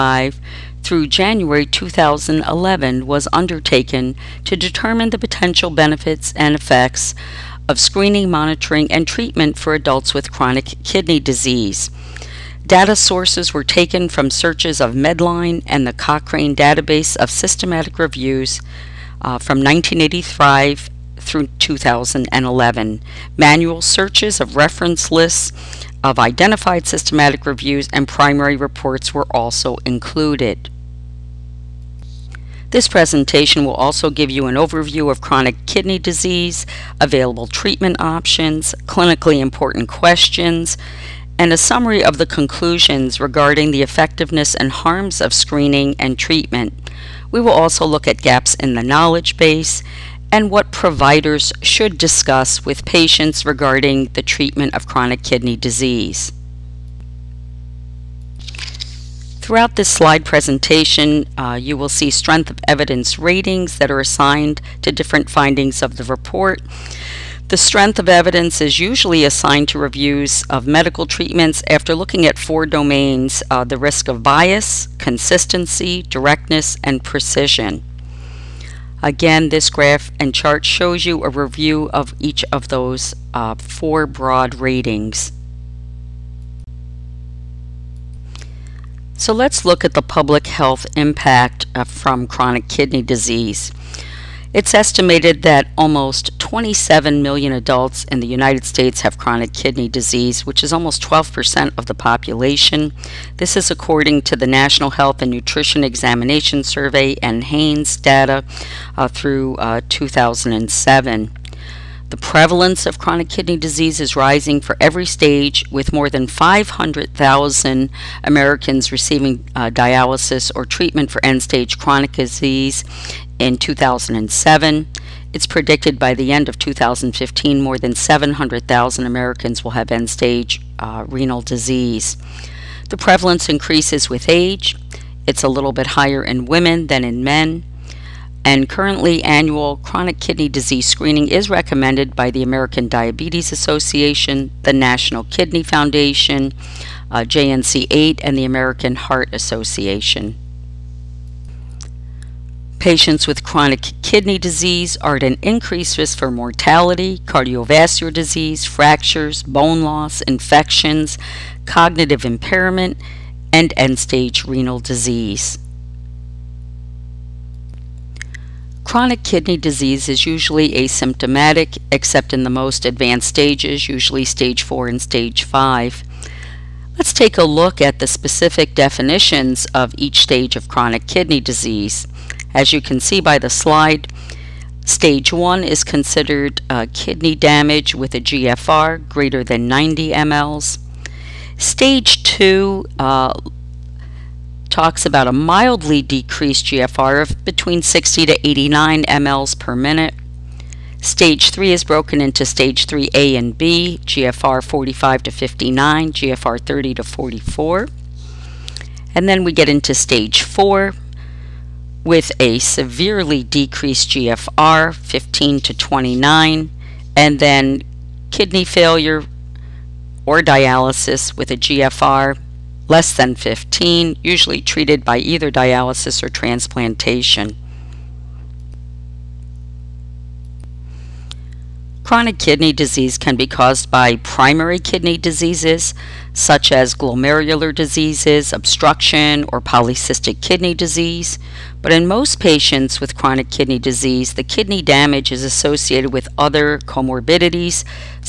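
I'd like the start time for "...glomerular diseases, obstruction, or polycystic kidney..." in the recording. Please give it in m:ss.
3:56.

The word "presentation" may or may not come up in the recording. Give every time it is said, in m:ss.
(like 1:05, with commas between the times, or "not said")
0:32, 1:00.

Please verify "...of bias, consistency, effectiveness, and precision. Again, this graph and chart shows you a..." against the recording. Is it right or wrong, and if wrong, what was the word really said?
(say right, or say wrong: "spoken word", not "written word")
wrong: "directness", not "effectiveness".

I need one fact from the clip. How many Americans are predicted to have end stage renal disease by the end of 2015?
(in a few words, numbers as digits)
more than 700,000.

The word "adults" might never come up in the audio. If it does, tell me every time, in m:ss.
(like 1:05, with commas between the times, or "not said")
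0:09, 1:37.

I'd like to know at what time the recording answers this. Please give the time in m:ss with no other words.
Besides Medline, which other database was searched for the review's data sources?
0:15.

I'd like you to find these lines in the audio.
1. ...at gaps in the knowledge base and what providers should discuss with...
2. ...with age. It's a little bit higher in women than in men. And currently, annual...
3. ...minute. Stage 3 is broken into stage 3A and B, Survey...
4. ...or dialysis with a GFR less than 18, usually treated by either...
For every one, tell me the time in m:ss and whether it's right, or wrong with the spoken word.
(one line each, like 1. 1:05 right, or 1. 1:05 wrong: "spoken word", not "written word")
1. 0:48 right
2. 2:14 right
3. 3:19 wrong: "GFR", not "Survey"
4. 3:40 wrong: "15", not "18".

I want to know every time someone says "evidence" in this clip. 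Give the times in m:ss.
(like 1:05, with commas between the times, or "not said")
1:02, 1:08.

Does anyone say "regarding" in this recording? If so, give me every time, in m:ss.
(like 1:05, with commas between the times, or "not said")
0:43, 0:53.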